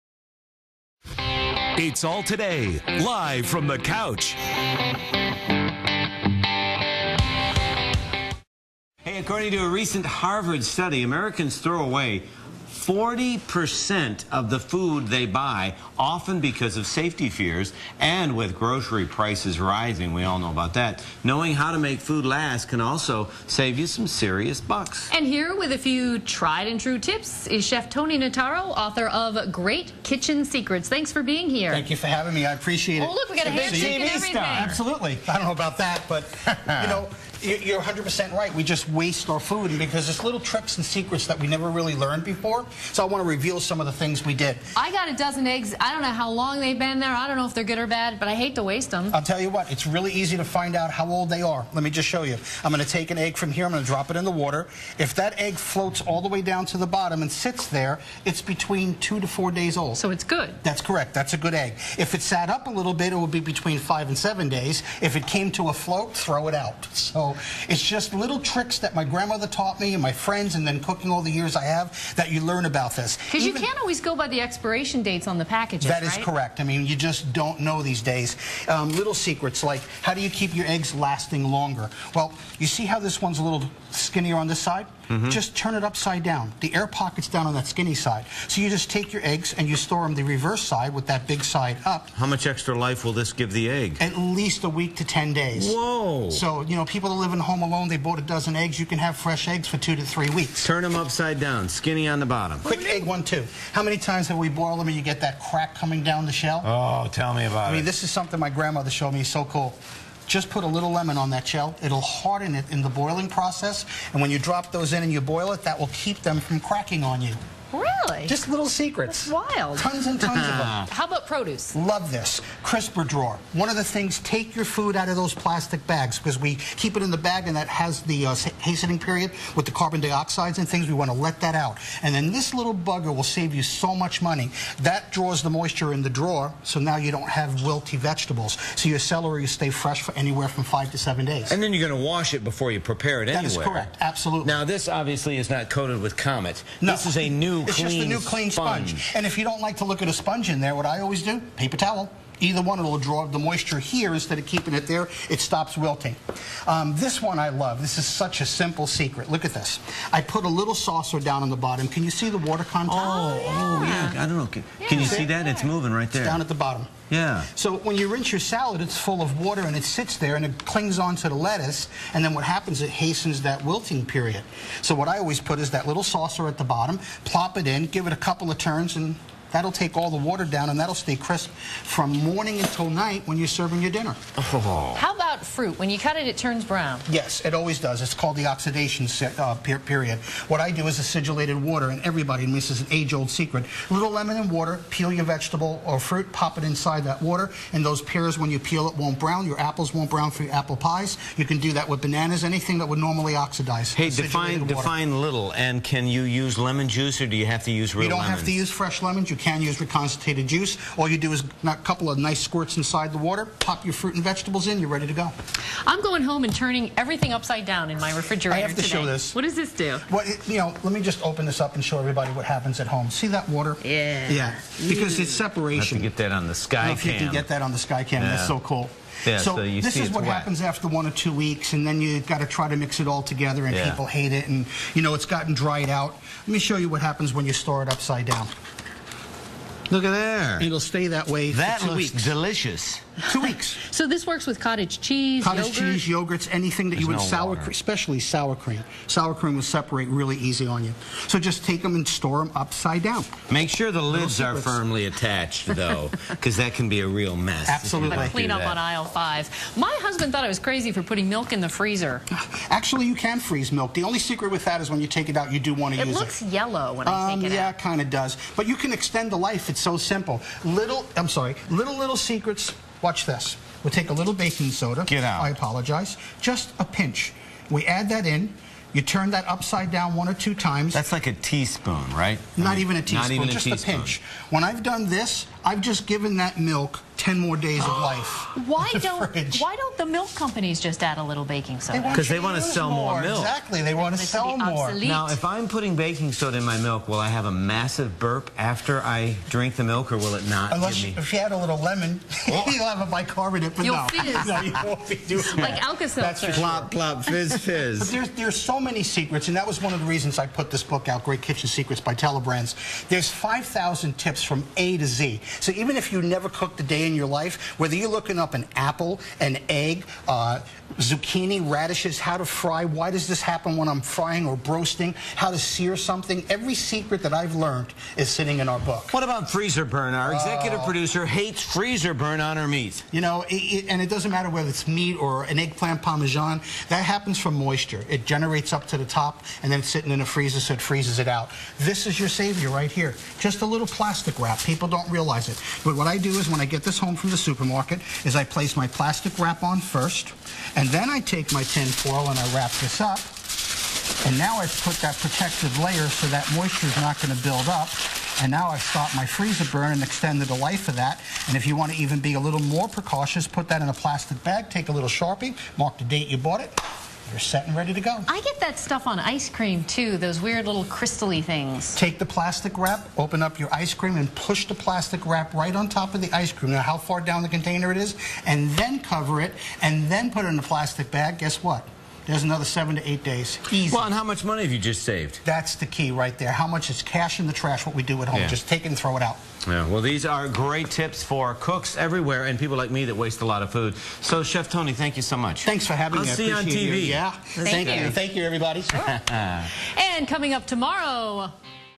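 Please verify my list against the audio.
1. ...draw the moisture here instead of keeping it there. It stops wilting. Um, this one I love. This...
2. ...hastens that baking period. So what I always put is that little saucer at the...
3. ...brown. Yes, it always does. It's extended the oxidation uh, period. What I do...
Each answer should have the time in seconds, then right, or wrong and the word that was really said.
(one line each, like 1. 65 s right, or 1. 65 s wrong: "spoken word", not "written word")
1. 152 s right
2. 172 s wrong: "wilting", not "baking"
3. 186 s wrong: "called", not "extended".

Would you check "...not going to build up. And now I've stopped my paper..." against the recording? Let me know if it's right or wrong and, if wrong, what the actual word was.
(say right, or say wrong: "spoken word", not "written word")
wrong: "freezer", not "paper".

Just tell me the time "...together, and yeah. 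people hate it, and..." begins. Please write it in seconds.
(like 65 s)
233 s.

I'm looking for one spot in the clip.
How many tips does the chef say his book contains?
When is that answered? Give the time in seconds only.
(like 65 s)
313 s.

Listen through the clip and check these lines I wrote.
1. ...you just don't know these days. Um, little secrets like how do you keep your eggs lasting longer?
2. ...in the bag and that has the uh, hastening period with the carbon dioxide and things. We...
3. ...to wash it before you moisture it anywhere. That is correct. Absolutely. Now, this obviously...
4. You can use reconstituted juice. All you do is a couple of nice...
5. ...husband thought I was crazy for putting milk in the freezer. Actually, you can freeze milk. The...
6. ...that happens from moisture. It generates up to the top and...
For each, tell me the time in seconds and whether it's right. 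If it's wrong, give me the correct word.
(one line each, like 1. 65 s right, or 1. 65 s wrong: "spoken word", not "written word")
1. 76 s right
2. 127 s right
3. 142 s wrong: "prepare", not "moisture"
4. 209 s right
5. 259 s right
6. 336 s right.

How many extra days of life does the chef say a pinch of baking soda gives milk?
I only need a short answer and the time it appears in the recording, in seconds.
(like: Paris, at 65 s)
10, at 287 s.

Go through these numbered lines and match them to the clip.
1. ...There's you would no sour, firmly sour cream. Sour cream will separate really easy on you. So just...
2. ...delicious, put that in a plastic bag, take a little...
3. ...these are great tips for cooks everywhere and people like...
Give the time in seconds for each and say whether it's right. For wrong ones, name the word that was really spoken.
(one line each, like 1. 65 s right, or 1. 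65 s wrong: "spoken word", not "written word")
1. 246 s wrong: "especially", not "firmly"
2. 362 s wrong: "precautious", not "delicious"
3. 390 s right.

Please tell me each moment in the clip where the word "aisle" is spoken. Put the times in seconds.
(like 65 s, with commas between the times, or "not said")
258 s.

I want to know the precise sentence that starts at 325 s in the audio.
how to sear something, every secret that I've learned is sitting in our book.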